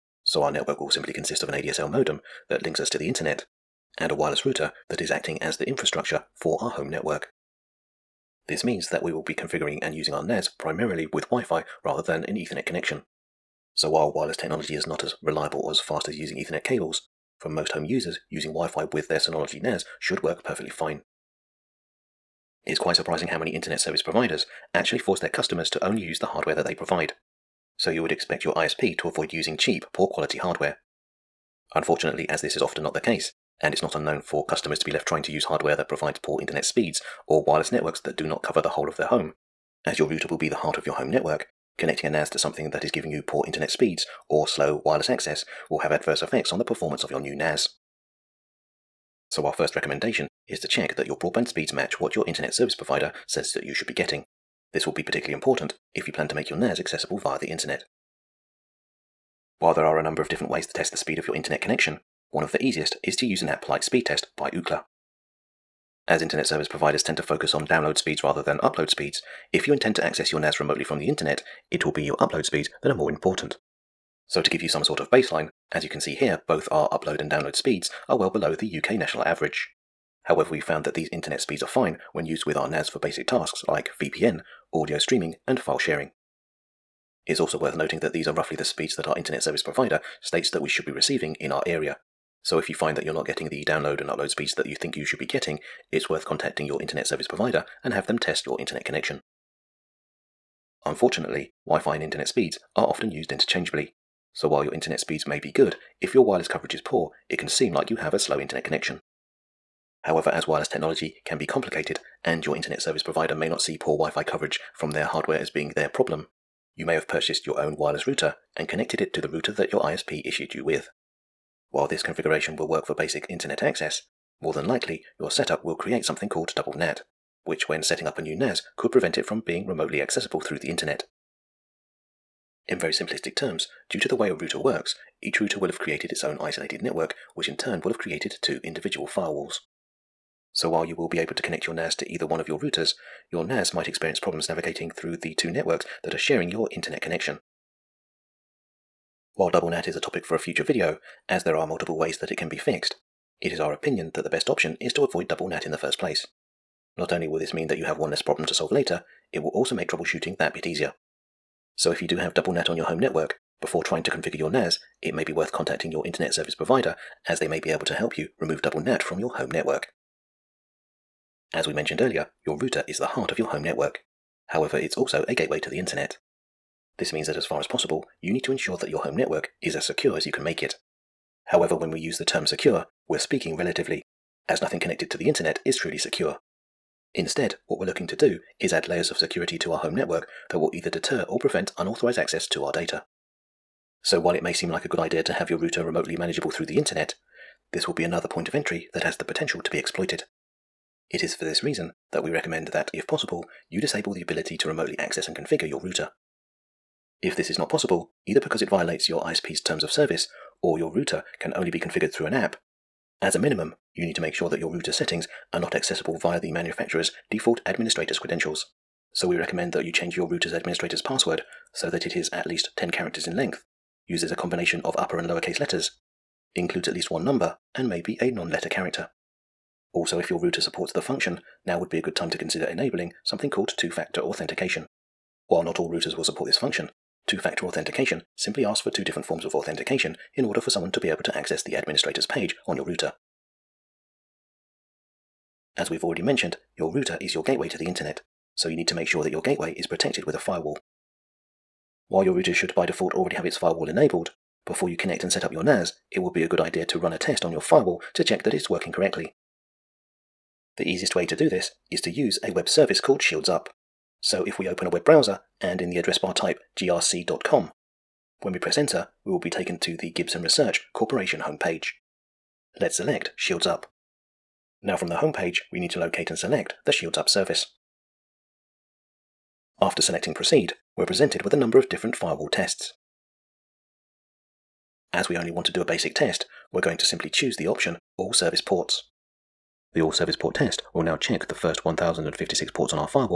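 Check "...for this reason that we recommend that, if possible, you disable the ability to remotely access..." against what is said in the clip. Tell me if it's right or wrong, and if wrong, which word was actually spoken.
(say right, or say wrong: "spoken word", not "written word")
right.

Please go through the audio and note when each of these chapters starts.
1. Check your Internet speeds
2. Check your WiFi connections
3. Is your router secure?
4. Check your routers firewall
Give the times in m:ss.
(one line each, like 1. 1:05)
1. 0:21
2. 1:37
3. 2:50
4. 4:04.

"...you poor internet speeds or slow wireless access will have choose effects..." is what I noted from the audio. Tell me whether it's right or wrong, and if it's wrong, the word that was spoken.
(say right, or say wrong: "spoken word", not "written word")
wrong: "adverse", not "choose".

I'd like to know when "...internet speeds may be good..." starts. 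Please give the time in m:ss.
1:44.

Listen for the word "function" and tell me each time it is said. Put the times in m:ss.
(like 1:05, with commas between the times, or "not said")
3:51, 3:56.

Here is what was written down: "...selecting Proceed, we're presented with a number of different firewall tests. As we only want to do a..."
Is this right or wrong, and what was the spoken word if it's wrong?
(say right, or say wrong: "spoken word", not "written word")
right.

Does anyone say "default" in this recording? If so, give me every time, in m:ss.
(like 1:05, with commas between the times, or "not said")
3:37, 4:12.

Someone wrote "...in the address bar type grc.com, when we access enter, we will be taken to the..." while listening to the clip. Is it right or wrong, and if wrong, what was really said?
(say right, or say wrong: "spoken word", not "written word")
wrong: "press", not "access".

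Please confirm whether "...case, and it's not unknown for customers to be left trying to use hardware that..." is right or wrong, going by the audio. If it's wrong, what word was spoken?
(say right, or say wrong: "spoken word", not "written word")
right.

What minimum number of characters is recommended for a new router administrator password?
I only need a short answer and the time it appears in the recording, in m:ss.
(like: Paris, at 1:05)
10, at 3:42.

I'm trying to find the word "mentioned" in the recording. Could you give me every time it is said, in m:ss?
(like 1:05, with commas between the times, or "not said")
2:51, 4:06.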